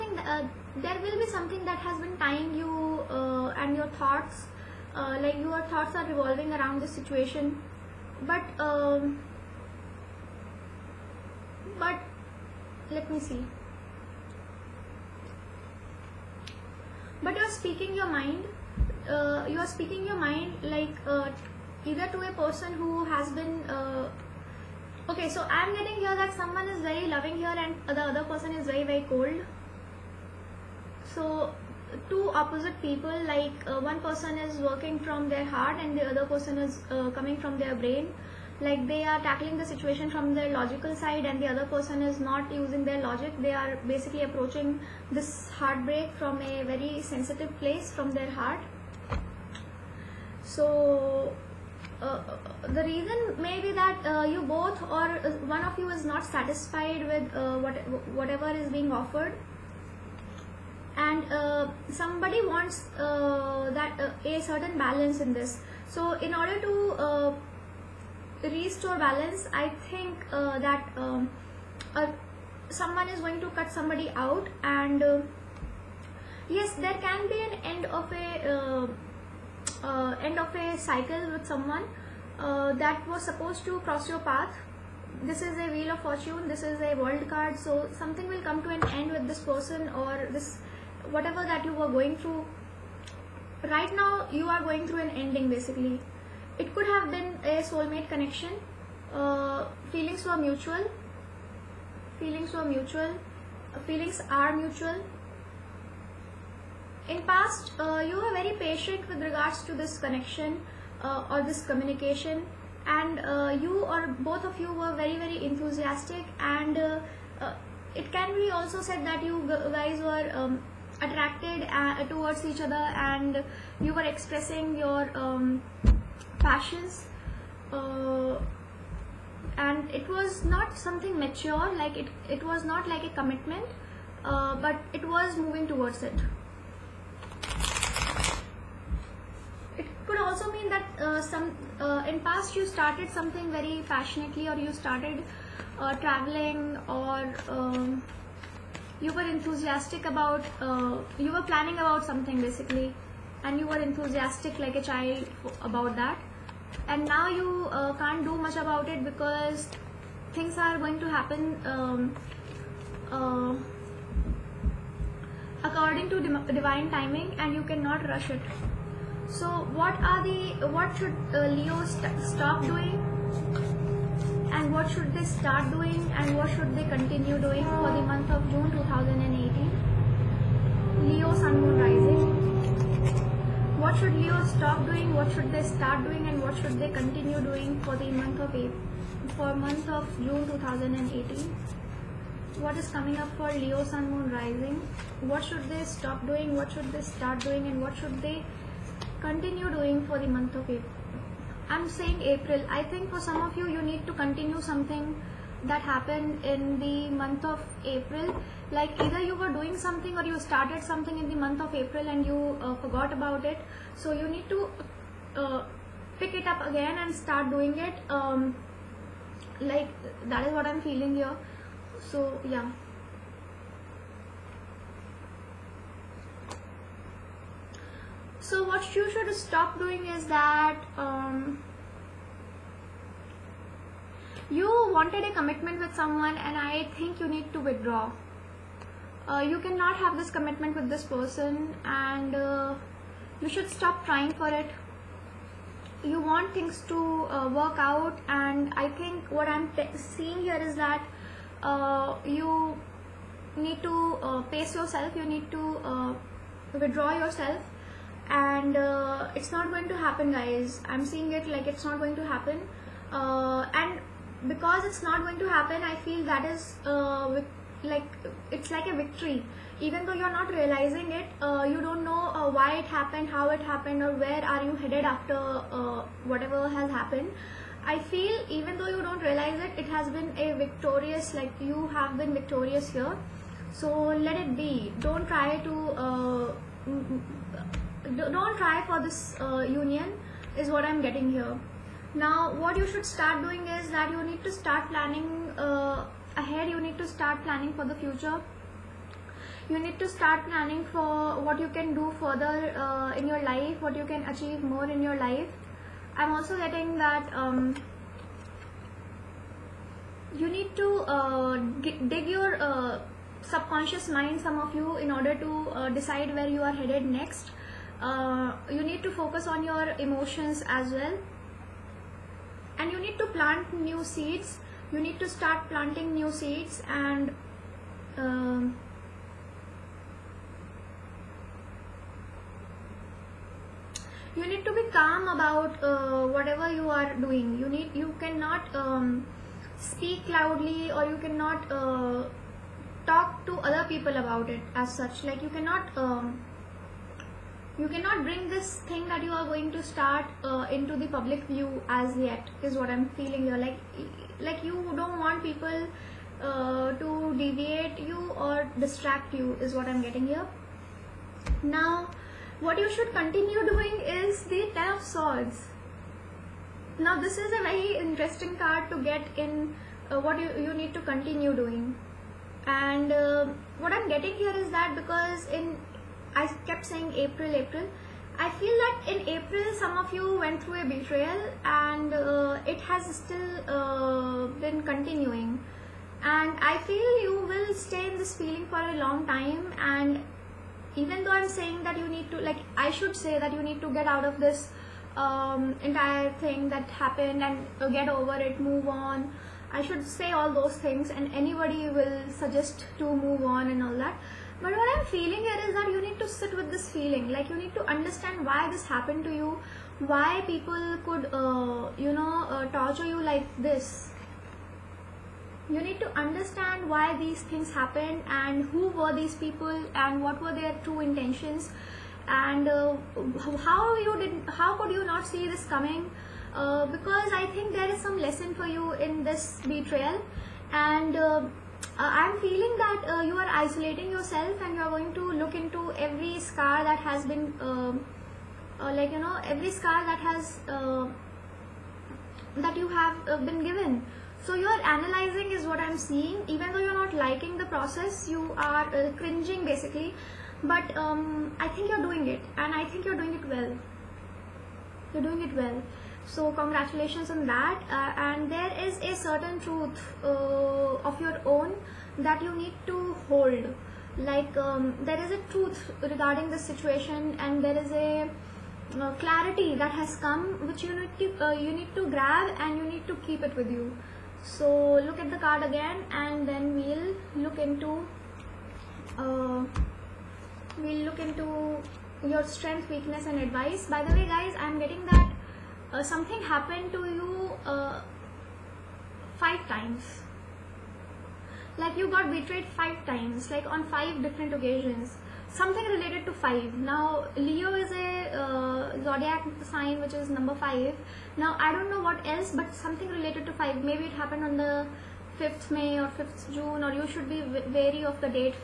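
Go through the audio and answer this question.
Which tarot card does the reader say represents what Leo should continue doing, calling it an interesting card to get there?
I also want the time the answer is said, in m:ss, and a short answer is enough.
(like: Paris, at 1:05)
Ten of Swords, at 6:04.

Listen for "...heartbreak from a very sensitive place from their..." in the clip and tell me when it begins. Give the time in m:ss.
0:45.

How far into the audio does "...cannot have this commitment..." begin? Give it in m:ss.
3:59.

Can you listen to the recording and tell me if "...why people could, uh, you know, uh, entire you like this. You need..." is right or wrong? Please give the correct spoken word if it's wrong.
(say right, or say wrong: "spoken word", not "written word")
wrong: "torture", not "entire".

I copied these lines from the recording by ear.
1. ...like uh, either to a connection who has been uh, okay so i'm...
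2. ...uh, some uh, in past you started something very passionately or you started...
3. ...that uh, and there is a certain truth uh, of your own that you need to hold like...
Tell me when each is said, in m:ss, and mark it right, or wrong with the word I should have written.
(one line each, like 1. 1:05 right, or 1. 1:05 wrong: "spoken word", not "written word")
1. 0:20 wrong: "person", not "connection"
2. 2:21 right
3. 7:37 right.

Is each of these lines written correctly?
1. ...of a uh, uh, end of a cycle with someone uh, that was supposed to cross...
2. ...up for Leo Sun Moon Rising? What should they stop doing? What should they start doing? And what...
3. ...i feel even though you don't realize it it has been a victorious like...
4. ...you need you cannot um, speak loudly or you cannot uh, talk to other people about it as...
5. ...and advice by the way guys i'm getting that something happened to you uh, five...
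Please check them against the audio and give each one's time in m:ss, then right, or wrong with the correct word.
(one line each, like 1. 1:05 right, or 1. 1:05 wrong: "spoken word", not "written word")
1. 1:17 right
2. 3:13 right
3. 4:37 right
4. 5:37 right
5. 8:03 right.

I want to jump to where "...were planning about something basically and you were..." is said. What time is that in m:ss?
2:31.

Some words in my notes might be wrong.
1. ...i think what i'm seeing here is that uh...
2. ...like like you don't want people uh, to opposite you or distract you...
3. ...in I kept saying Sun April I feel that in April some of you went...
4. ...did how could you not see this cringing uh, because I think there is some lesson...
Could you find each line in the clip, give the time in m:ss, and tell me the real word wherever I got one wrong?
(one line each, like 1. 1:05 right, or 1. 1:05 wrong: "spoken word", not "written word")
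1. 4:08 right
2. 5:53 wrong: "deviate", not "opposite"
3. 6:15 wrong: "April", not "Sun"
4. 7:04 wrong: "coming", not "cringing".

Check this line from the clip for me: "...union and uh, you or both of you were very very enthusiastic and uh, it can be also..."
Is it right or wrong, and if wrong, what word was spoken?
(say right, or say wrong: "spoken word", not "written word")
wrong: "communication", not "union".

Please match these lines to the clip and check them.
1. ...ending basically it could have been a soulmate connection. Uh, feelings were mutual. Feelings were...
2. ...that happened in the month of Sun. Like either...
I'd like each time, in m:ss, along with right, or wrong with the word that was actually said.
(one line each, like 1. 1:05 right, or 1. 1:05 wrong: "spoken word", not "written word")
1. 1:35 right
2. 3:25 wrong: "April", not "Sun".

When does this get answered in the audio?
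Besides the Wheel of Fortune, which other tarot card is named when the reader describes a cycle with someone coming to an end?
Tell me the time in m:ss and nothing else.
1:26.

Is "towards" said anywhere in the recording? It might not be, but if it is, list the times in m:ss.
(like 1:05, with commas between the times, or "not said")
2:02, 2:15.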